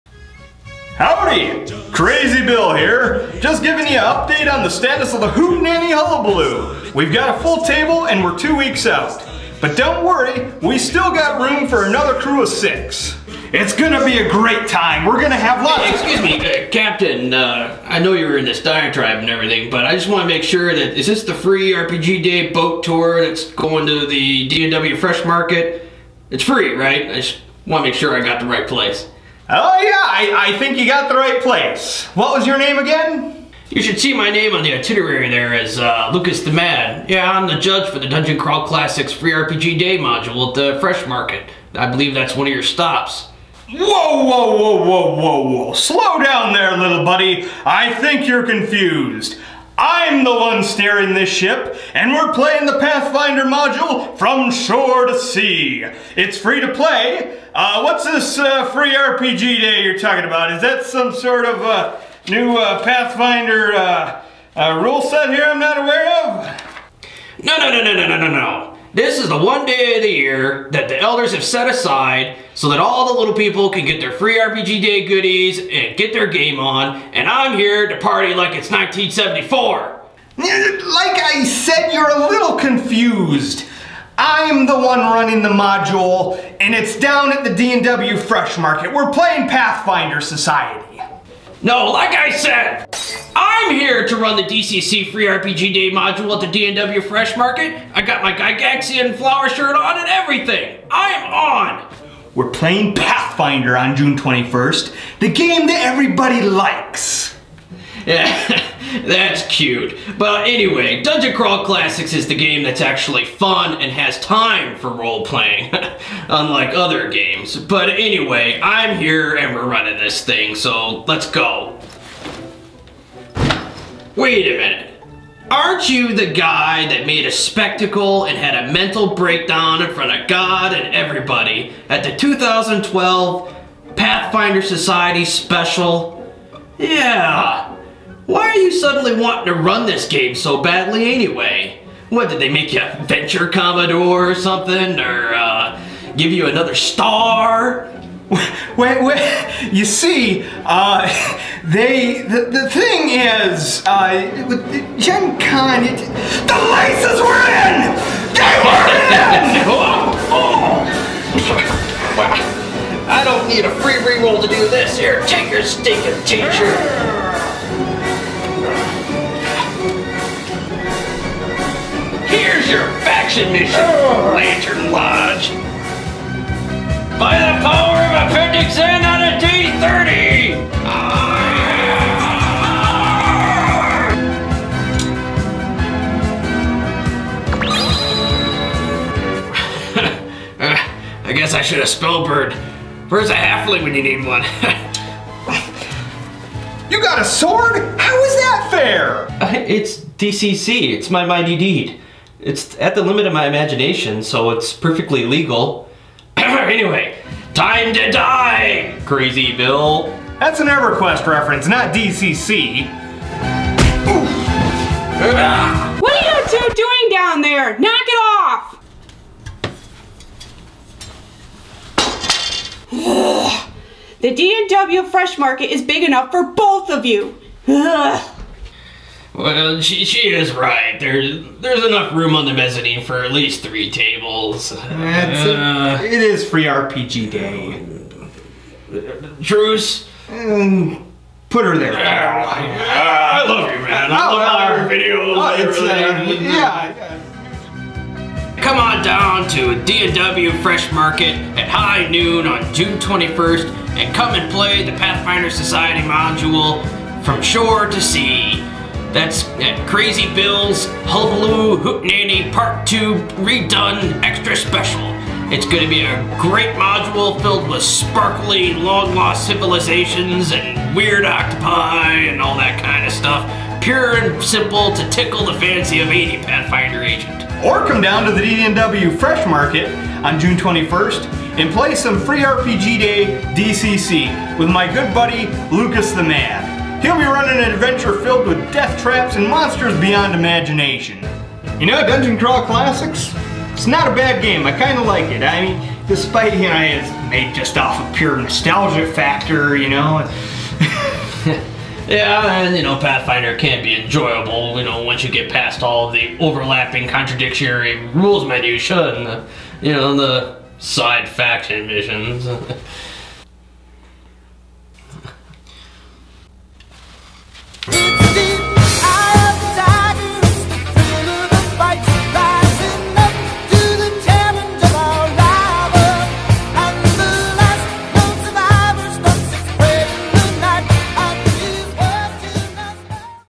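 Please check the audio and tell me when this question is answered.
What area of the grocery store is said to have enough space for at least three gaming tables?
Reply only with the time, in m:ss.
3:52.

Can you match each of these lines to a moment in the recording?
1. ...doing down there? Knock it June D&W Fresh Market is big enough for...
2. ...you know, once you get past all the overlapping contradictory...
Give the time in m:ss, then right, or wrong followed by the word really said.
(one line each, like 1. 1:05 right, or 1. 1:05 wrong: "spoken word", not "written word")
1. 3:36 wrong: "The", not "June"
2. 5:04 right.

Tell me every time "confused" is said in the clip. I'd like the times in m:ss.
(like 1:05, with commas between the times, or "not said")
0:48, 1:22.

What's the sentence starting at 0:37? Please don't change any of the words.
Yeah, I'm the judge for the Dungeon Crawl Classics Free RPG Day module at the Fresh Market.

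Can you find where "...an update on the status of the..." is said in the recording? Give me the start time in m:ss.
0:03.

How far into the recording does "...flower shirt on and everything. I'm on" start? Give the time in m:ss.
1:39.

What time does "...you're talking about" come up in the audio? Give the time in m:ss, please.
0:59.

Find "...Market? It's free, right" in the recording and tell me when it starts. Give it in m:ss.
0:25.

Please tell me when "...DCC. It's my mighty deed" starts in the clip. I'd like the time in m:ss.
3:20.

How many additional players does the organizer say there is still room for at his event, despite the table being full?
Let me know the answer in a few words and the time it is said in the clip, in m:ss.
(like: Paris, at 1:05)
6, at 0:12.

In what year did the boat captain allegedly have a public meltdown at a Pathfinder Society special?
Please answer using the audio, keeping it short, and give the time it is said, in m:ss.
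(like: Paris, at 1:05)
2012, at 2:12.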